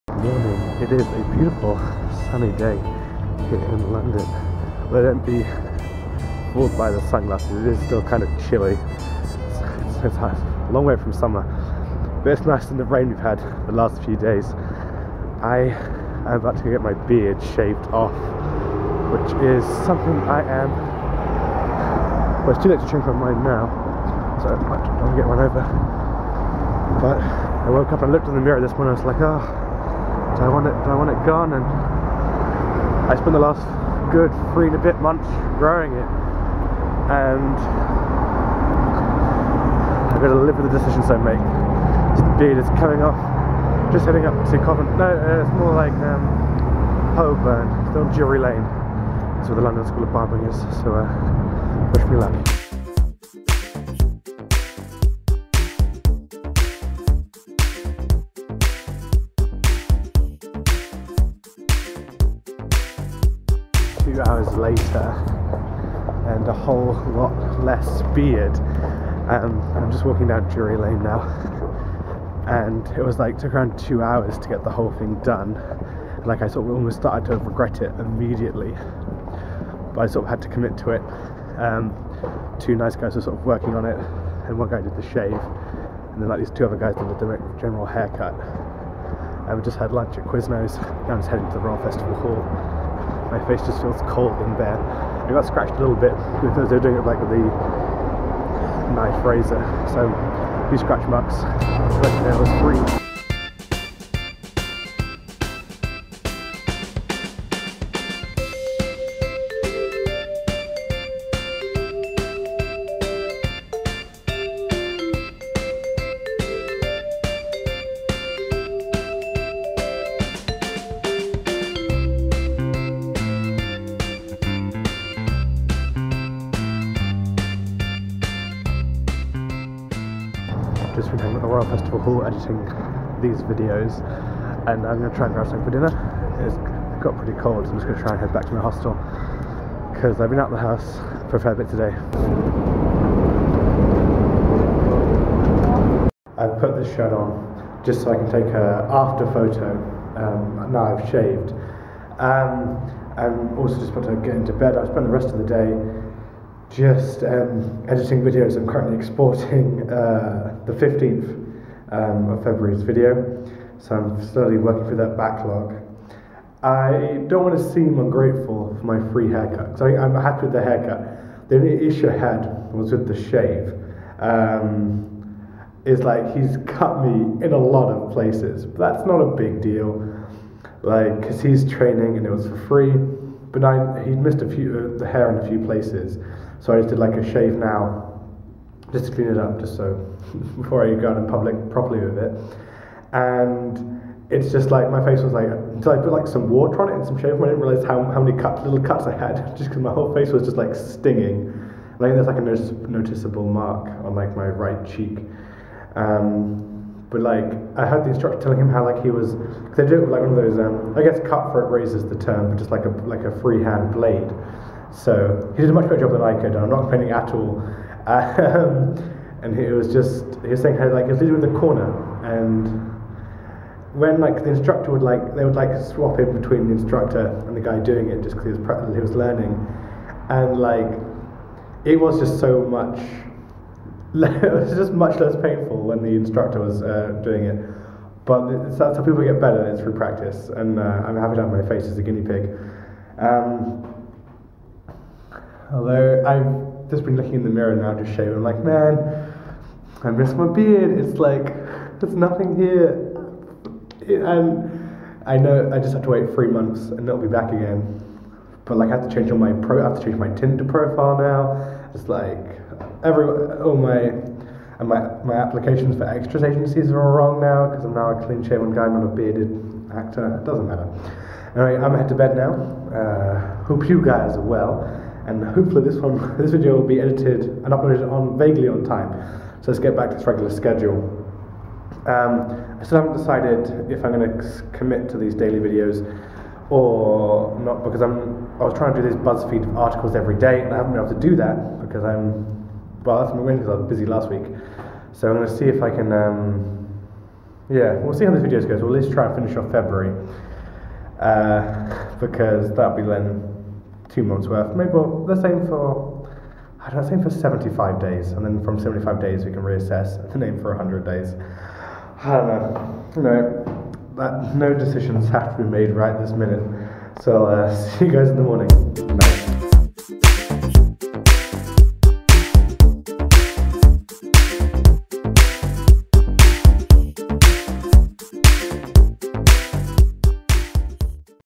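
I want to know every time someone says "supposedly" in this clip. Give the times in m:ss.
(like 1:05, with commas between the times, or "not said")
not said.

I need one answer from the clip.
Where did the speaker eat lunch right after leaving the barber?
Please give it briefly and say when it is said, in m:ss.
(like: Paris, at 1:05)
Quiznos, at 1:30.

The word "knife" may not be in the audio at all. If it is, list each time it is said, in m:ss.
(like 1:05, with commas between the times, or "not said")
1:38.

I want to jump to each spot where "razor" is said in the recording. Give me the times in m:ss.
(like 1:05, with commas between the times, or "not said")
1:39, 3:31.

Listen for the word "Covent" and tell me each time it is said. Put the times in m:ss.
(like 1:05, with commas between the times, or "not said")
0:44.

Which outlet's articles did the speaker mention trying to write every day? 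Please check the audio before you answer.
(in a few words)
BuzzFeed.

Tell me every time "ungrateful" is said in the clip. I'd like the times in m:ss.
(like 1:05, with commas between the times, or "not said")
2:47.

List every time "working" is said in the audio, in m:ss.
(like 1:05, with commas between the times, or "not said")
1:23, 2:44.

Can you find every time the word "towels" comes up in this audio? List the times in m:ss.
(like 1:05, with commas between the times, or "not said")
not said.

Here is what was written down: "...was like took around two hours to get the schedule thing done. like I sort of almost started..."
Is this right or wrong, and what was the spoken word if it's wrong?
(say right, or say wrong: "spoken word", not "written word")
wrong: "whole", not "schedule".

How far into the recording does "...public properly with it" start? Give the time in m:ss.
3:11.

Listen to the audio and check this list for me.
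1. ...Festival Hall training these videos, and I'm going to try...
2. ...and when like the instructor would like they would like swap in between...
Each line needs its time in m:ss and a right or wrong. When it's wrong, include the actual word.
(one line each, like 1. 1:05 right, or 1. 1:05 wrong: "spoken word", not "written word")
1. 2:11 wrong: "editing", not "training"
2. 3:42 right.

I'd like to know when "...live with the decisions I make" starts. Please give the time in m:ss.
0:40.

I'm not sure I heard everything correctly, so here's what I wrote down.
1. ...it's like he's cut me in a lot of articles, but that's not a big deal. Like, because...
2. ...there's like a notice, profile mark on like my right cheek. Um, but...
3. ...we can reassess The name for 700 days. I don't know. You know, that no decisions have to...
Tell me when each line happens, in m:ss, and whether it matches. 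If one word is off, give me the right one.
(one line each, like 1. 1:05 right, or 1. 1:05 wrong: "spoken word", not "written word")
1. 2:55 wrong: "places", not "articles"
2. 3:22 wrong: "noticeable", not "profile"
3. 5:09 wrong: "100", not "700".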